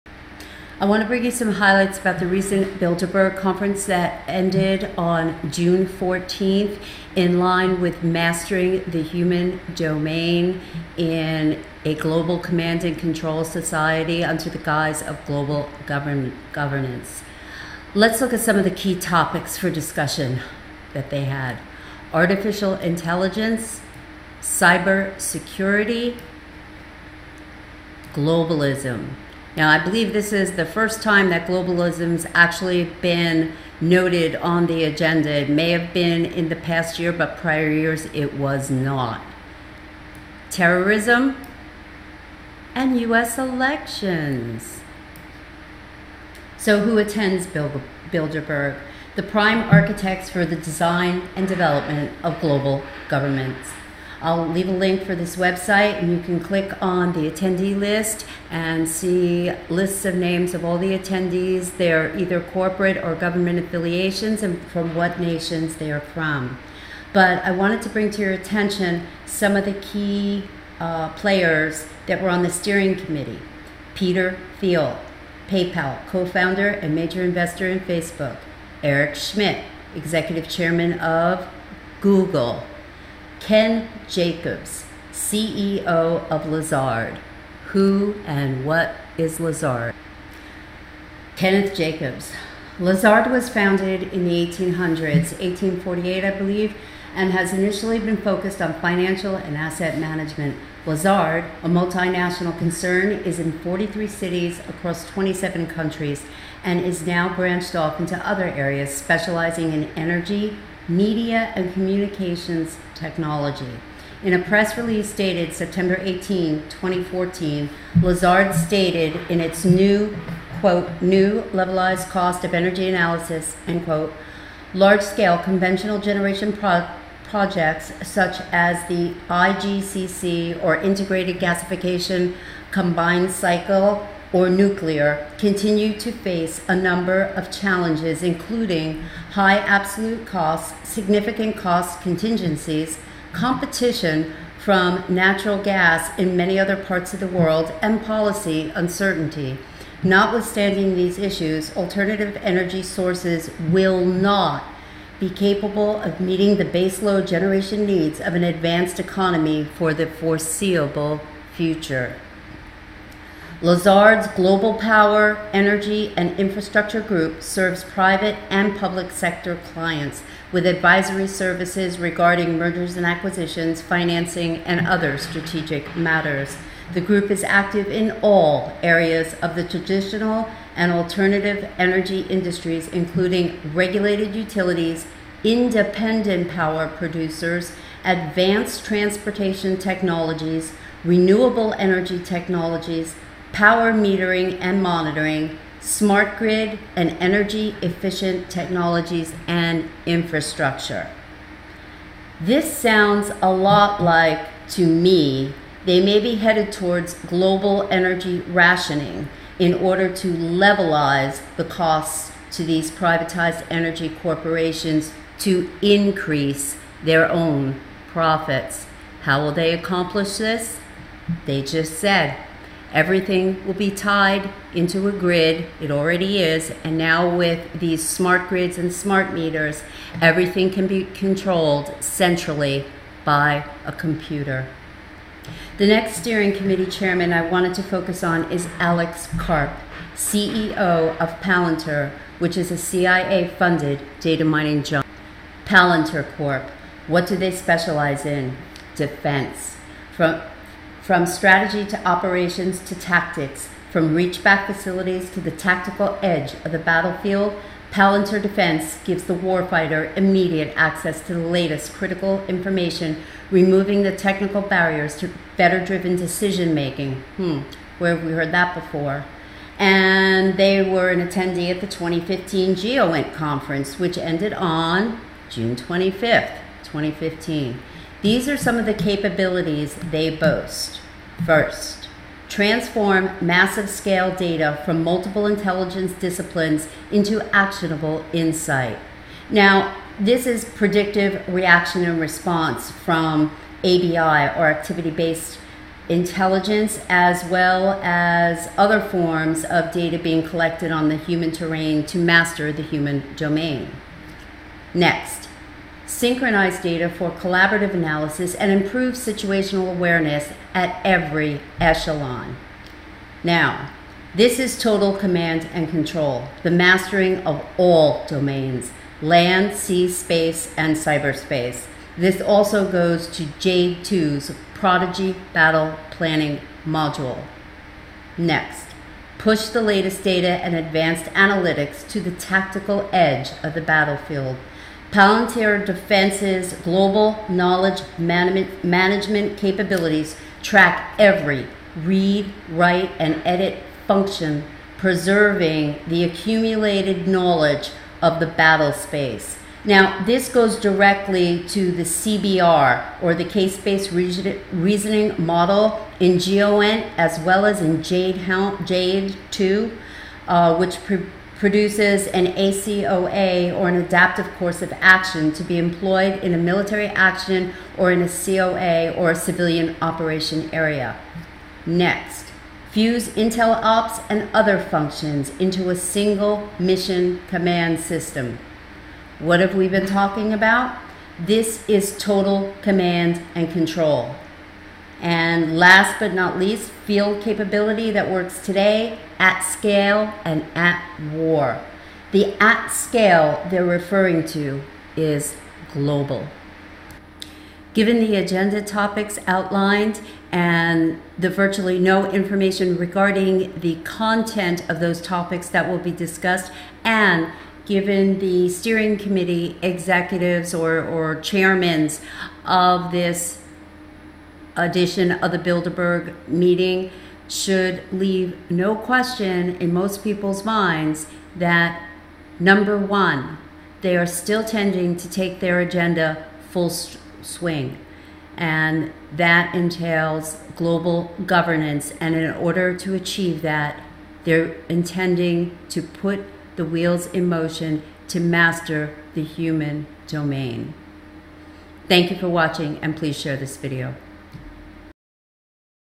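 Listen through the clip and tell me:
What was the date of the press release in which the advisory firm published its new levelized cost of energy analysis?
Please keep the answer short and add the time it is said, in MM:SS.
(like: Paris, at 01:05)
September 18, 2014, at 01:55.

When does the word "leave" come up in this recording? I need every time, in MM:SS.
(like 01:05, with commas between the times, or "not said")
00:54, 06:58.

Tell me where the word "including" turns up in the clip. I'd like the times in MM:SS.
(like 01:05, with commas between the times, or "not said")
02:18, 03:02.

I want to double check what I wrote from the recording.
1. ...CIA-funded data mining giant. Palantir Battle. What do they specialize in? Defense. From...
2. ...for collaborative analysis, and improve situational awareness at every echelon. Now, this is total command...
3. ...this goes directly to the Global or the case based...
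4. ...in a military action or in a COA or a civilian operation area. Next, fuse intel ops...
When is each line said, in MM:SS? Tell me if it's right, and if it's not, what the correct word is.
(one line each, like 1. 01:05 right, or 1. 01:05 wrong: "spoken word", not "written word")
1. 04:02 wrong: "Corp", not "Battle"
2. 05:07 right
3. 05:50 wrong: "CBR", not "Global"
4. 06:06 right.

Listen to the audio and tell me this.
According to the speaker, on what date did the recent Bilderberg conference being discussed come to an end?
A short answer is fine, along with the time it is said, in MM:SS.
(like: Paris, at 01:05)
June 14th, at 00:05.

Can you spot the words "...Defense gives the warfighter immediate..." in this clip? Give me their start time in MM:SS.
04:18.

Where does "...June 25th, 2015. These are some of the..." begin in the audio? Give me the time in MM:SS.
04:35.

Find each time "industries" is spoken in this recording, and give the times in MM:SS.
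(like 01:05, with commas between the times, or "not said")
03:02.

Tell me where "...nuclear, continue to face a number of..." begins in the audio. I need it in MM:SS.
02:14.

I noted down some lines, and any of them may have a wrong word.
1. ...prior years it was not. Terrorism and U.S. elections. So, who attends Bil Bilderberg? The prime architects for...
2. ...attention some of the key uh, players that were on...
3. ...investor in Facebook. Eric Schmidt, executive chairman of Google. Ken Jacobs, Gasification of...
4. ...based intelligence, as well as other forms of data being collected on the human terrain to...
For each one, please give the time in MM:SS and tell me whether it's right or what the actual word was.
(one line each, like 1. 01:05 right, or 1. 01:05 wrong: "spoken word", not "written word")
1. 00:37 right
2. 01:08 right
3. 01:17 wrong: "CEO", not "Gasification"
4. 04:55 right.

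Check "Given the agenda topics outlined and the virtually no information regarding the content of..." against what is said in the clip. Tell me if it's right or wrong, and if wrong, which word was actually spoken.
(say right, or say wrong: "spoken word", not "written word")
right.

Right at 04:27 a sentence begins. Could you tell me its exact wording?
Hmm, where have we heard that before?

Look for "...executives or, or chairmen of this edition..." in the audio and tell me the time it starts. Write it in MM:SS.
06:49.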